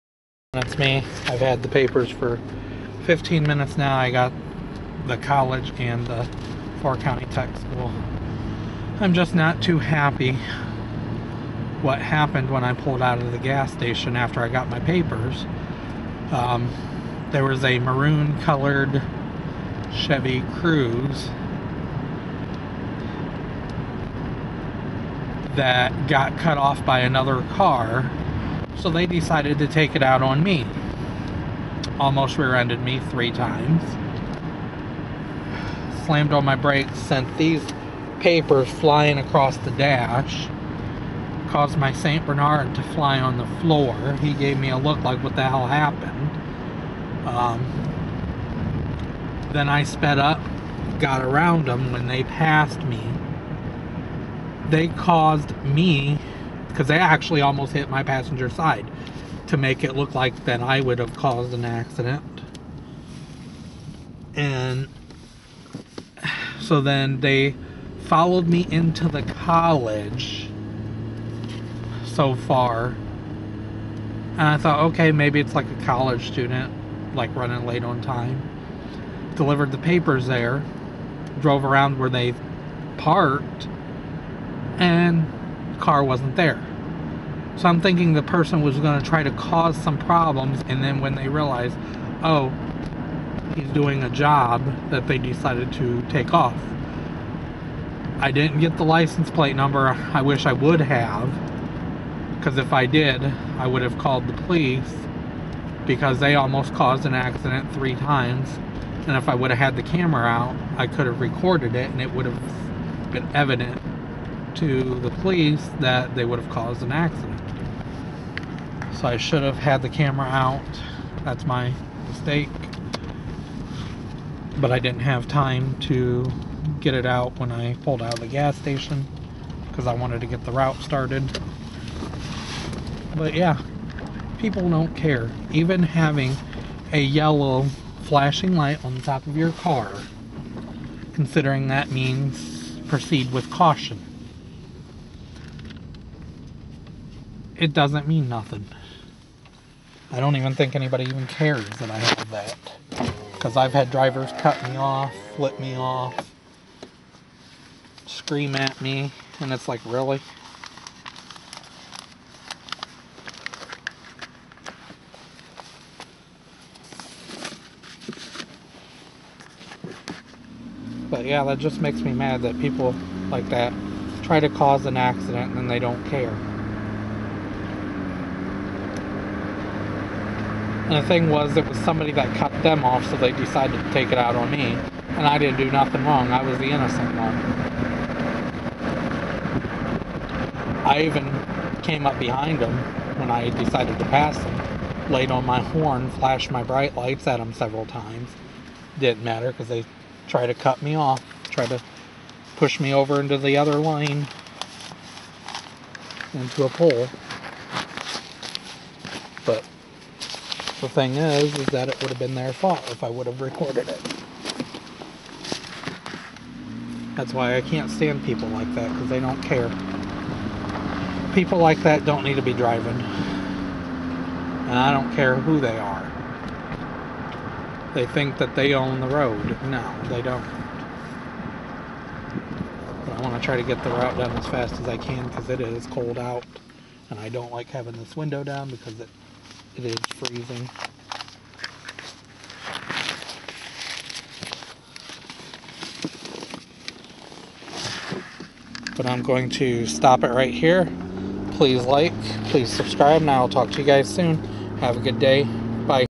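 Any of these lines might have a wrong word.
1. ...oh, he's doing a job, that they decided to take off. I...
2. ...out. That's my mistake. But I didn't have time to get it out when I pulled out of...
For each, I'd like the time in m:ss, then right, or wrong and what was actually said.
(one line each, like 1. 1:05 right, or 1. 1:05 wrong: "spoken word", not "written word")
1. 1:32 right
2. 2:00 right.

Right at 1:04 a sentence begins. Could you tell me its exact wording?
And so then they followed me into the college so far.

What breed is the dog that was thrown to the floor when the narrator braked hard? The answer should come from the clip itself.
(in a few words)
St. Bernard.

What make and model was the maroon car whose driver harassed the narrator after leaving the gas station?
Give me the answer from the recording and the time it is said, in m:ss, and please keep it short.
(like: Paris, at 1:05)
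Chevy Cruze, at 0:19.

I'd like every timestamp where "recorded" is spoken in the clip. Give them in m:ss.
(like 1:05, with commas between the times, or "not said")
1:51, 3:33.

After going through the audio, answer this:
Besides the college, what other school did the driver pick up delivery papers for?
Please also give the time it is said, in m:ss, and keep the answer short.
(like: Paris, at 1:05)
Four County Tech School, at 0:06.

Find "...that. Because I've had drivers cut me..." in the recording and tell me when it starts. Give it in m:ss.
2:32.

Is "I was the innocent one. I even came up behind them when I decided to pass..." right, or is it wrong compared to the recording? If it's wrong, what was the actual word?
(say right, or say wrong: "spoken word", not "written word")
right.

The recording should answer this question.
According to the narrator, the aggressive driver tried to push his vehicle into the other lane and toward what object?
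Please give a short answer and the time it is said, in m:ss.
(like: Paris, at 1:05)
a pole, at 3:26.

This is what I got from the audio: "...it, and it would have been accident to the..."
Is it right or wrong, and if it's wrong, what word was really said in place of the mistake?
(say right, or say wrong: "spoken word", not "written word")
wrong: "evident", not "accident".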